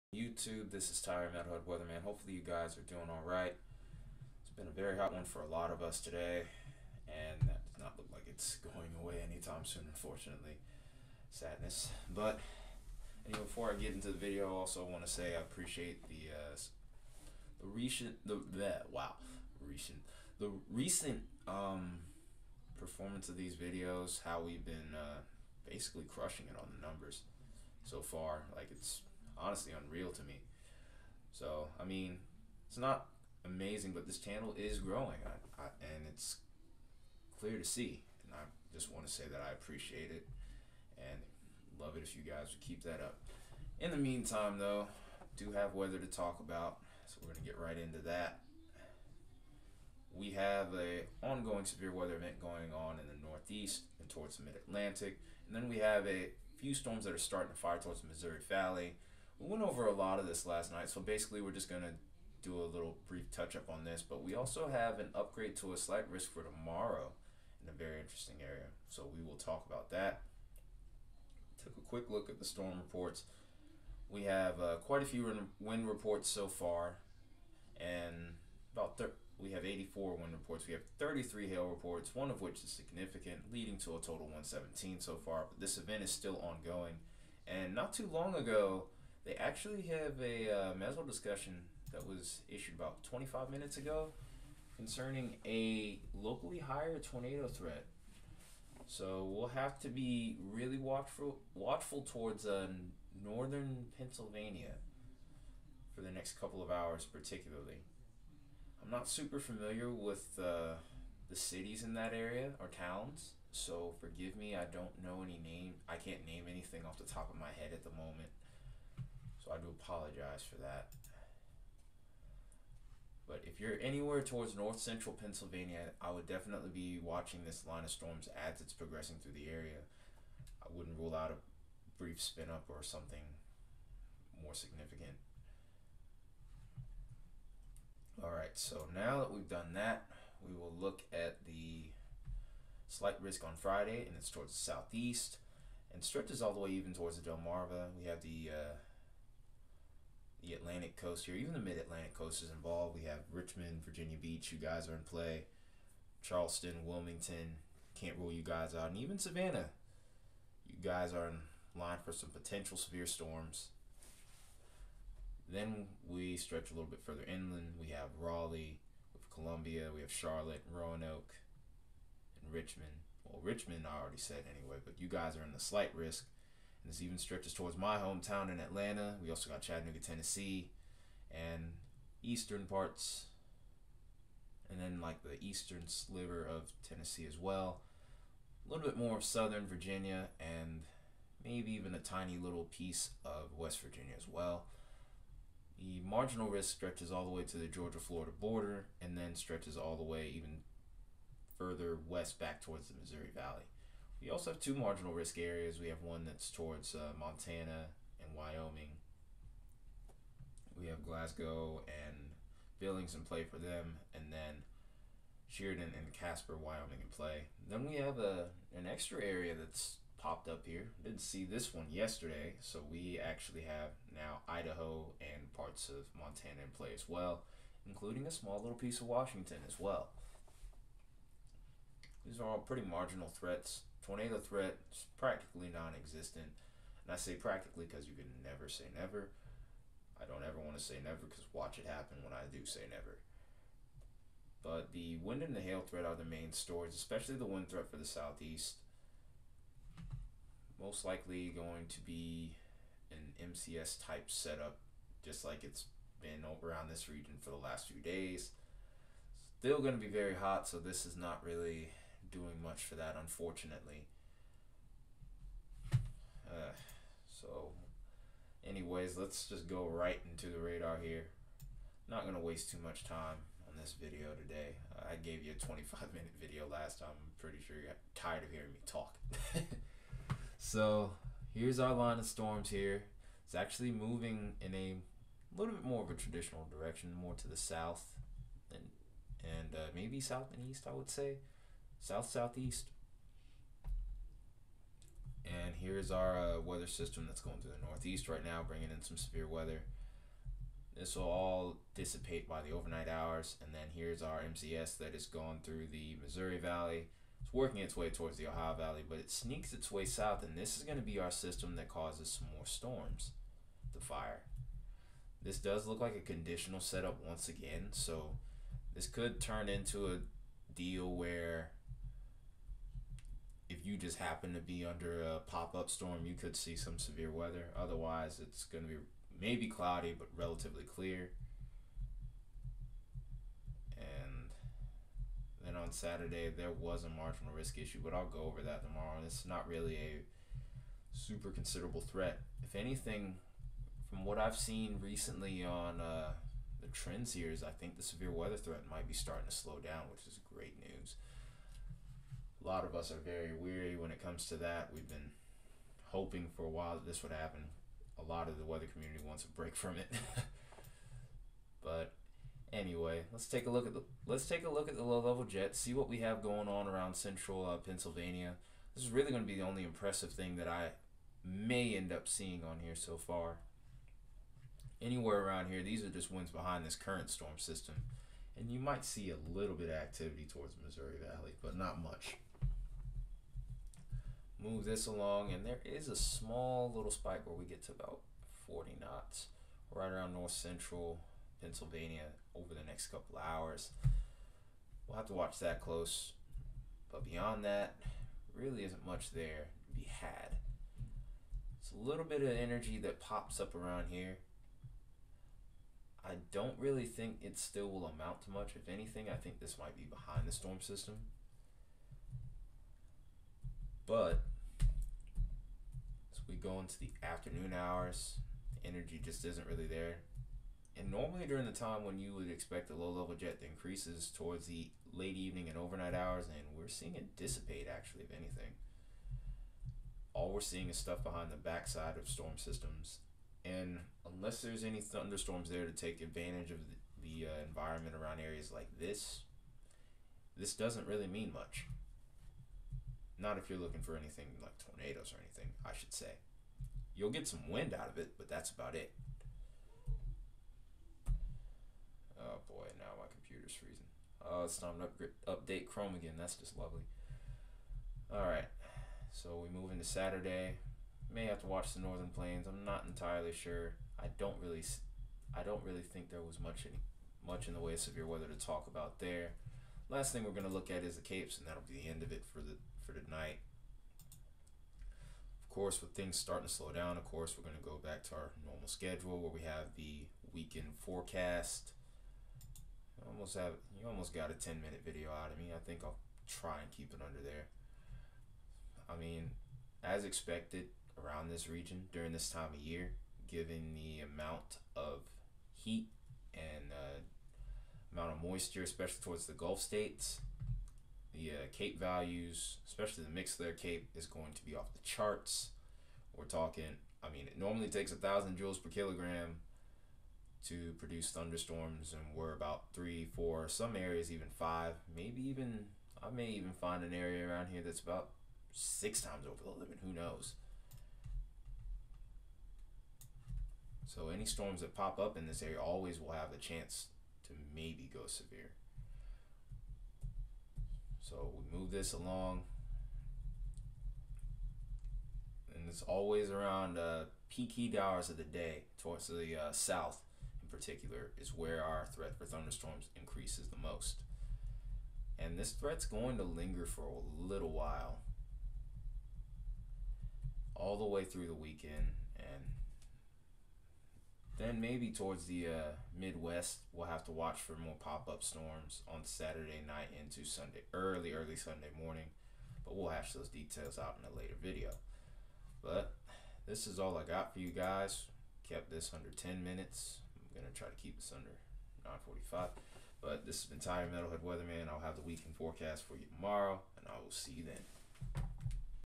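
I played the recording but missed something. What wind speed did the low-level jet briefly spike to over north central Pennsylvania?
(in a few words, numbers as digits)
40 knots.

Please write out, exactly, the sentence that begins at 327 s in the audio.
Otherwise, it's going to be maybe cloudy but relatively clear.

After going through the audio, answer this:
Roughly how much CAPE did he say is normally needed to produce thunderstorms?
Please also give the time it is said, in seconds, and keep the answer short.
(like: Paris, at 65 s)
1,000 J/kg, at 508 s.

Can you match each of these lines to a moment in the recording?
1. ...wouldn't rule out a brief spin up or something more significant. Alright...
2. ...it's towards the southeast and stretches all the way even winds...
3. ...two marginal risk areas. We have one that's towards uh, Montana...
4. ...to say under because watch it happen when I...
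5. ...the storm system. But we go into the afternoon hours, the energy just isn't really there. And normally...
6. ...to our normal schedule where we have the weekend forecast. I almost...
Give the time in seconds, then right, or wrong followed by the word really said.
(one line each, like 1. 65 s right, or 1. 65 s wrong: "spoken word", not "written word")
1. 130 s right
2. 144 s wrong: "towards", not "winds"
3. 204 s right
4. 240 s wrong: "never", not "under"
5. 410 s right
6. 478 s right.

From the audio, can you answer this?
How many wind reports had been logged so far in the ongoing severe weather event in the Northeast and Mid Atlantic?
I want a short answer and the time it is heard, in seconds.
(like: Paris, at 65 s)
84, at 79 s.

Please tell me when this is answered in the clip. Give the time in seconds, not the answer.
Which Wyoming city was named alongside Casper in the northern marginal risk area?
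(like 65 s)
215 s.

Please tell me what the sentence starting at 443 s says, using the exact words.
Not if you're looking for anything like tornadoes or anything, I should say.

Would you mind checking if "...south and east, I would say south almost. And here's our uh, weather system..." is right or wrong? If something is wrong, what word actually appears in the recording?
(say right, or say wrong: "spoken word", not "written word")
wrong: "southeast", not "almost".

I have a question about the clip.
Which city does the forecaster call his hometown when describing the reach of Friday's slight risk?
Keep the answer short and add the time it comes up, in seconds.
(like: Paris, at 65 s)
Atlanta, at 178 s.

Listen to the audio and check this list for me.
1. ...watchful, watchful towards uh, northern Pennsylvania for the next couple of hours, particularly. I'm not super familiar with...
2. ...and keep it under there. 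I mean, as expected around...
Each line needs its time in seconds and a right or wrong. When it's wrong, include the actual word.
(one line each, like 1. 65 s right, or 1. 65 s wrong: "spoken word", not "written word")
1. 100 s right
2. 486 s right.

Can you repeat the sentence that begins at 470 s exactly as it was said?
Last thing we're gonna look at is the Capes, and that'll be the end of it for the for tonight.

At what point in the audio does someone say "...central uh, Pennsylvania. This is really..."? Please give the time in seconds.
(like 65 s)
367 s.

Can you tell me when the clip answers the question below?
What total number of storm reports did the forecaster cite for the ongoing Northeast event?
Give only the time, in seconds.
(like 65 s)
84 s.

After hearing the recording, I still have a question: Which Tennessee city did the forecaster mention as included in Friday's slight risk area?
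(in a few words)
Chattanooga.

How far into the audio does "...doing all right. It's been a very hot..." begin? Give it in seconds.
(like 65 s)
2 s.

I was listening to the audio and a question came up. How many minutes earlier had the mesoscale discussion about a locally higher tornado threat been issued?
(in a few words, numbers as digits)
25 minutes.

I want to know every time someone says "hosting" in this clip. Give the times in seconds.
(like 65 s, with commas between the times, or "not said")
not said.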